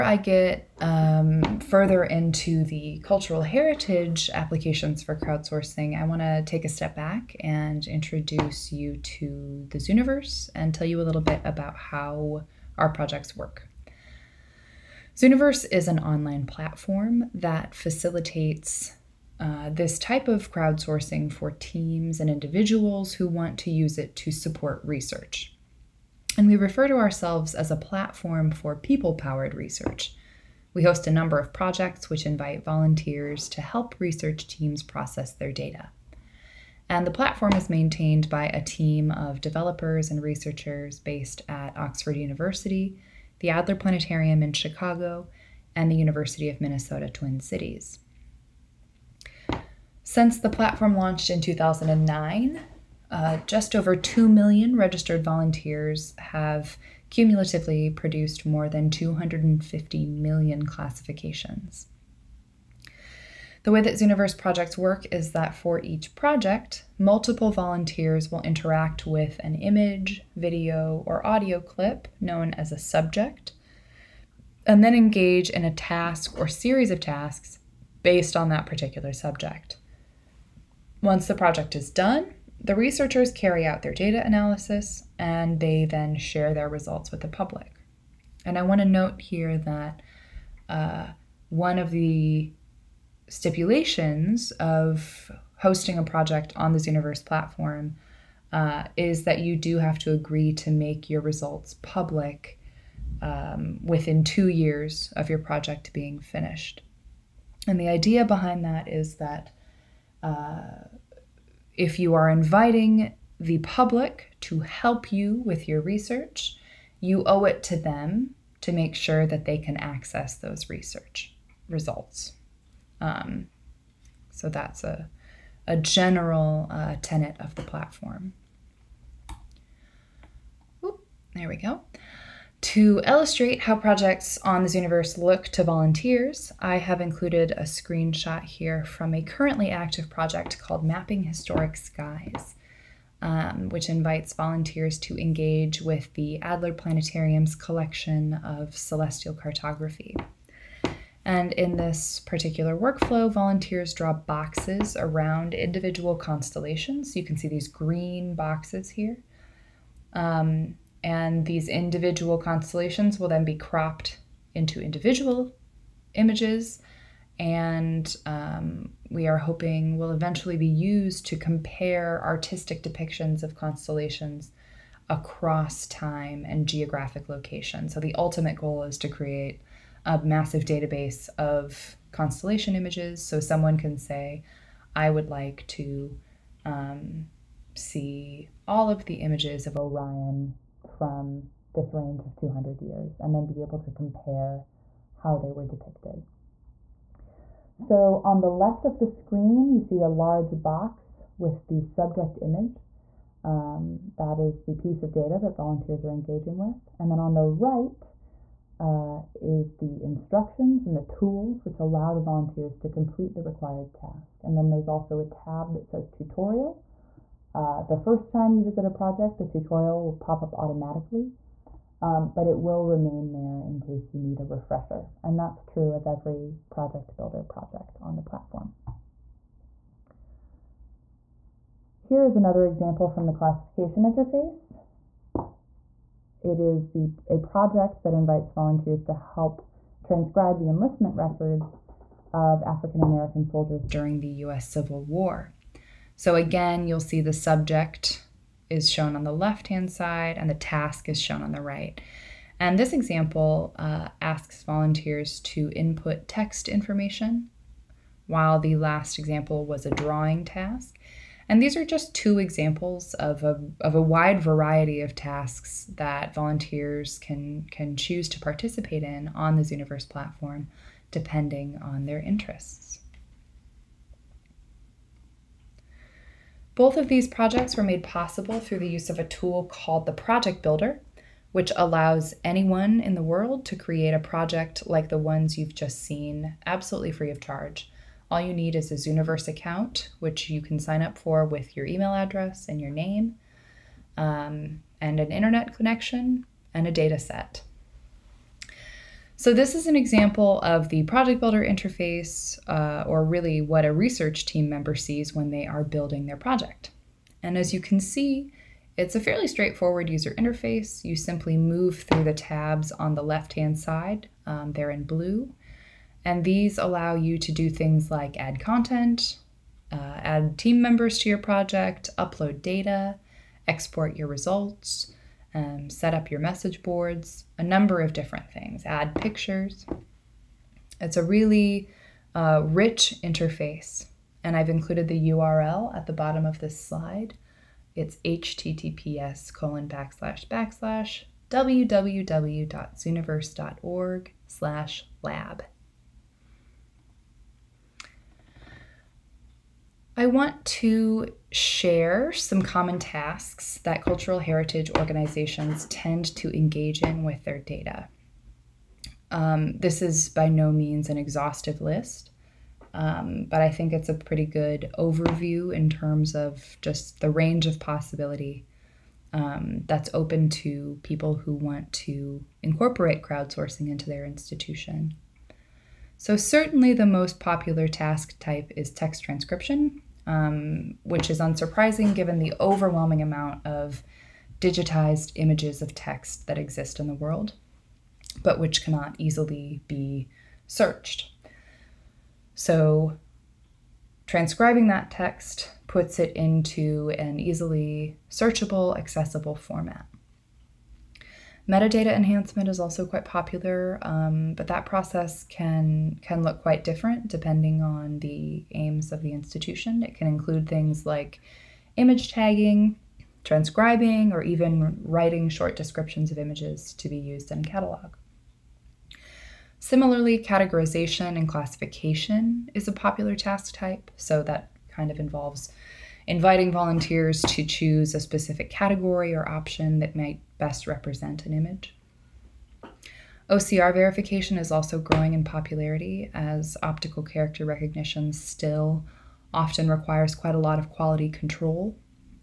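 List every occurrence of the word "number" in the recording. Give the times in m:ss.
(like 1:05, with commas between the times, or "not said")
0:31, 5:27.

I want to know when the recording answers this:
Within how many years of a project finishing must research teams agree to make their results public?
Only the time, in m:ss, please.
1:44.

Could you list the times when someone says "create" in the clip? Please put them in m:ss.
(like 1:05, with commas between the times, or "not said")
2:59, 4:43.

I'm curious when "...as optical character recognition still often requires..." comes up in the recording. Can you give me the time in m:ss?
7:16.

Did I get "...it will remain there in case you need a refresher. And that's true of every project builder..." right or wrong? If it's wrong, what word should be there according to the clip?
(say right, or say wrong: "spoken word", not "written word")
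right.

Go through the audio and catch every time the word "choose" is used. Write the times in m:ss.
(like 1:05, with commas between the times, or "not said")
4:27, 7:07.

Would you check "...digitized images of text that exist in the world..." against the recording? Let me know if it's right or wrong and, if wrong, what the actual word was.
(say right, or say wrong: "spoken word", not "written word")
right.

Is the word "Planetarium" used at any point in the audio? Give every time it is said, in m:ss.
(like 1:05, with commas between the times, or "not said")
0:43, 2:26.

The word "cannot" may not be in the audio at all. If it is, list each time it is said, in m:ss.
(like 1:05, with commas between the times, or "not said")
6:28.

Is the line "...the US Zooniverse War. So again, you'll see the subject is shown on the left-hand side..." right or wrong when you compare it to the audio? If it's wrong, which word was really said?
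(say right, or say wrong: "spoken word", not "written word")
wrong: "Civil", not "Zooniverse".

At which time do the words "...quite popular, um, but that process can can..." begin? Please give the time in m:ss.
6:43.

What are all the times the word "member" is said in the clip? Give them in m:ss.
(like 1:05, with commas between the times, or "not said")
5:04, 5:20.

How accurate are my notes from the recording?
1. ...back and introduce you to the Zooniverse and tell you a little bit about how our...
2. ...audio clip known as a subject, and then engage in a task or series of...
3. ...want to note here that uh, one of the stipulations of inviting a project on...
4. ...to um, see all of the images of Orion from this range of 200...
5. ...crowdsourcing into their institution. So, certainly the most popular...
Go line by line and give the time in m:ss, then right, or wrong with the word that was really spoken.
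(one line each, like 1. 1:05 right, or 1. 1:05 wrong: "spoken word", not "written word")
1. 0:06 right
2. 1:11 right
3. 1:28 wrong: "hosting", not "inviting"
4. 3:05 right
5. 6:13 right.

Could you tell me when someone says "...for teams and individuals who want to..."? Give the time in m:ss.
0:21.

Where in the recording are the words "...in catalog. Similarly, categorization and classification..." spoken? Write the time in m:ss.
6:57.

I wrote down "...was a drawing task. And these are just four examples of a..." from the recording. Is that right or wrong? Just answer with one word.
wrong.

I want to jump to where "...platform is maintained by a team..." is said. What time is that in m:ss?
0:37.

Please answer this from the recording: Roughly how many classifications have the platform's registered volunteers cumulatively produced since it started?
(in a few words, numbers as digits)
250 million.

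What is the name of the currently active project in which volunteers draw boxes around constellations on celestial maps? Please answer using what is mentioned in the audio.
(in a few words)
Mapping Historic Skies.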